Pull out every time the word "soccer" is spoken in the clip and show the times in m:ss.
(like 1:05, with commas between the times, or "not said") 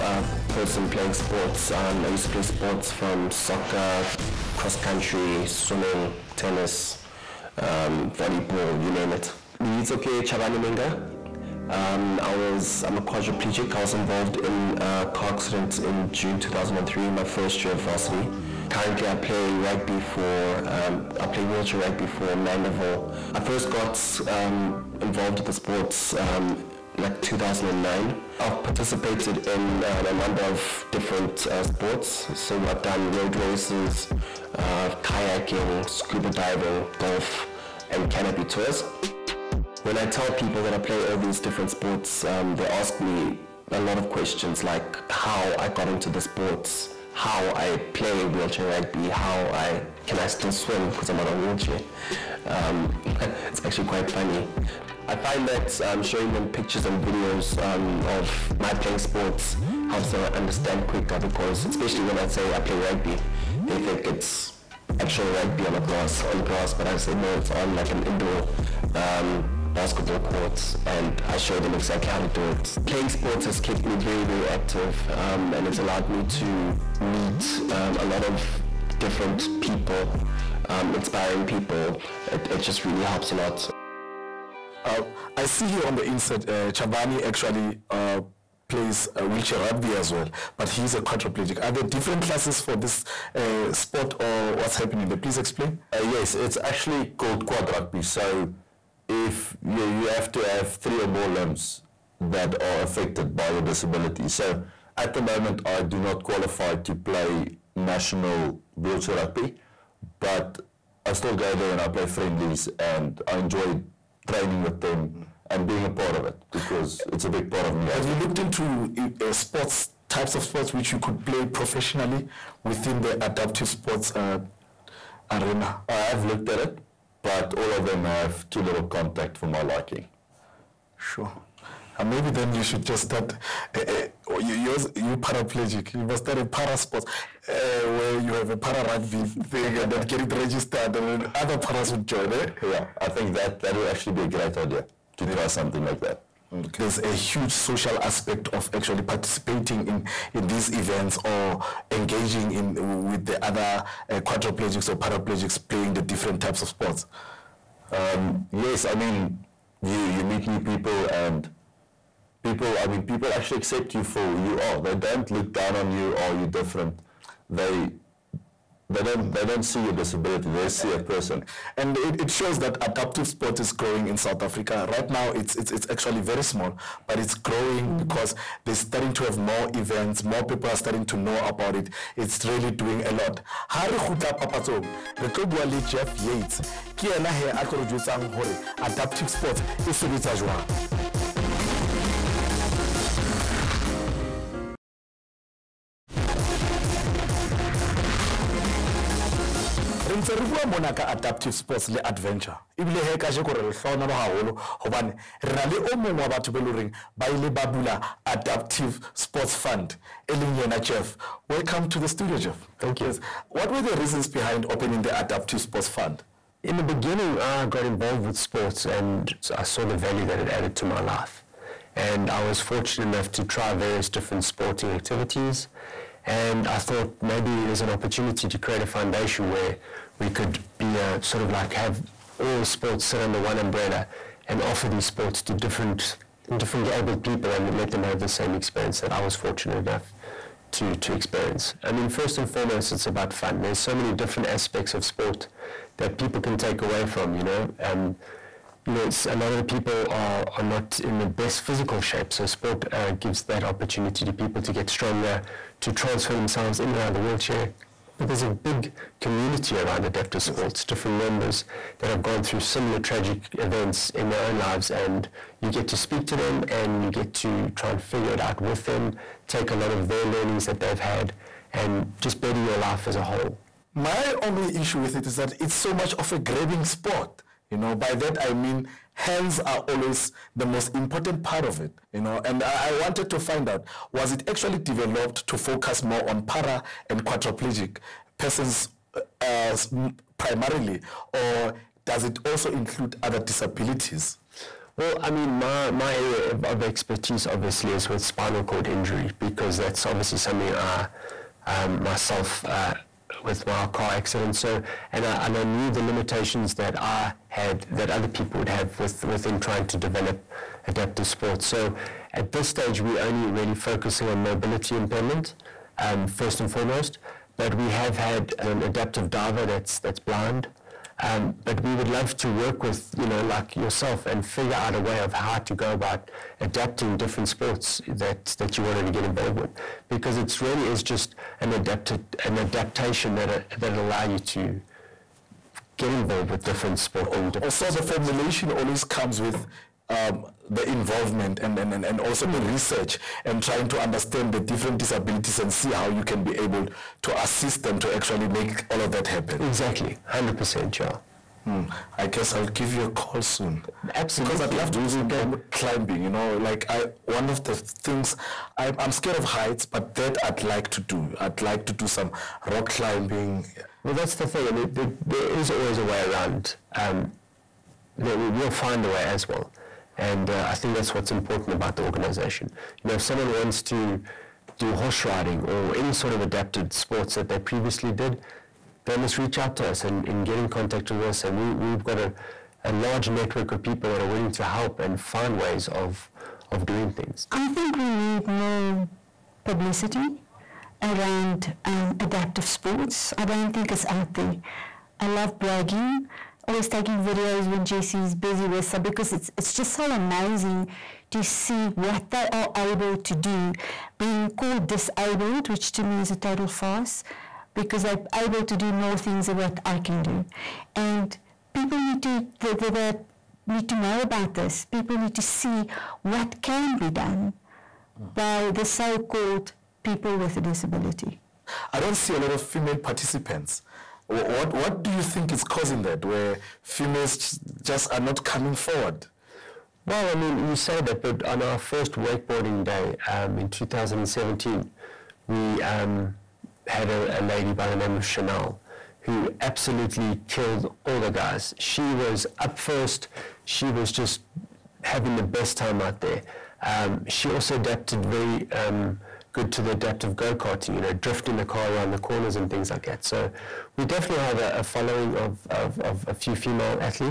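0:03.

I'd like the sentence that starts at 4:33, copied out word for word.
My only issue with it is that it's so much of a grabbing sport.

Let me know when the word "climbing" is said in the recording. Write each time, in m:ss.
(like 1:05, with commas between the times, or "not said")
5:55, 6:02.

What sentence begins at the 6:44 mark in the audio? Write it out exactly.
Being called disabled, which to me is a total farce, because they're able to do more things than what I can do.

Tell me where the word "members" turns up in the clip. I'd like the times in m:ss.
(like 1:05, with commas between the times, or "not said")
4:21.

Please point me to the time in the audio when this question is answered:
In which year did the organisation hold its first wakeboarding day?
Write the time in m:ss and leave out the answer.
7:13.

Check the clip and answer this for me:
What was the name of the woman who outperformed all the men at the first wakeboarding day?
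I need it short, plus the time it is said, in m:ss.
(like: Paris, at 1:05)
Chanel, at 7:18.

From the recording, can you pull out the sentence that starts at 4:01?
I mean, first and foremost, it's about fun.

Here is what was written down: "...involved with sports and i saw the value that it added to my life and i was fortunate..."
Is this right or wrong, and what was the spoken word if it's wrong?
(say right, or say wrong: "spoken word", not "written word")
right.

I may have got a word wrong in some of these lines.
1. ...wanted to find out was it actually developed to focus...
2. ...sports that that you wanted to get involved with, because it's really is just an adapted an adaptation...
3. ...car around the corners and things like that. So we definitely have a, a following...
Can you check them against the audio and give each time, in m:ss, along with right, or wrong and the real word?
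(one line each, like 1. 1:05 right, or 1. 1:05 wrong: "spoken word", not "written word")
1. 4:42 right
2. 5:27 right
3. 7:31 right.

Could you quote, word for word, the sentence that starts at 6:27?
I think we need more publicity around um, adaptive sports.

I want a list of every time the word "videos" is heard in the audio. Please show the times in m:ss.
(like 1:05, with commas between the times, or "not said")
0:57, 6:37.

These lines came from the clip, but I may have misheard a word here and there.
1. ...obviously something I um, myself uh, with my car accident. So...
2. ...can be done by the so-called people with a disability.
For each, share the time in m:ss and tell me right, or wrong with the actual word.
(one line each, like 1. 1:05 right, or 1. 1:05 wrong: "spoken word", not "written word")
1. 5:00 right
2. 6:56 right.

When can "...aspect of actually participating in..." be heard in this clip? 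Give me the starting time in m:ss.
2:28.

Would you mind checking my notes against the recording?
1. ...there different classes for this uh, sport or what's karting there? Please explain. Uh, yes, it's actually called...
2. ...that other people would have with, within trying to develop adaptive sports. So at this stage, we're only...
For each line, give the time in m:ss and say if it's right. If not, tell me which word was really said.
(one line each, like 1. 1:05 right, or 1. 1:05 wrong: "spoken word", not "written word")
1. 1:31 wrong: "happening", not "karting"
2. 5:07 right.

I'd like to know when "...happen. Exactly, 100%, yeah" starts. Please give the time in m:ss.
5:49.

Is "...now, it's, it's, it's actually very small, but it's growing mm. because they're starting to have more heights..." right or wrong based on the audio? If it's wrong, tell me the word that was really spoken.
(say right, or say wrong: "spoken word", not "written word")
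wrong: "events", not "heights".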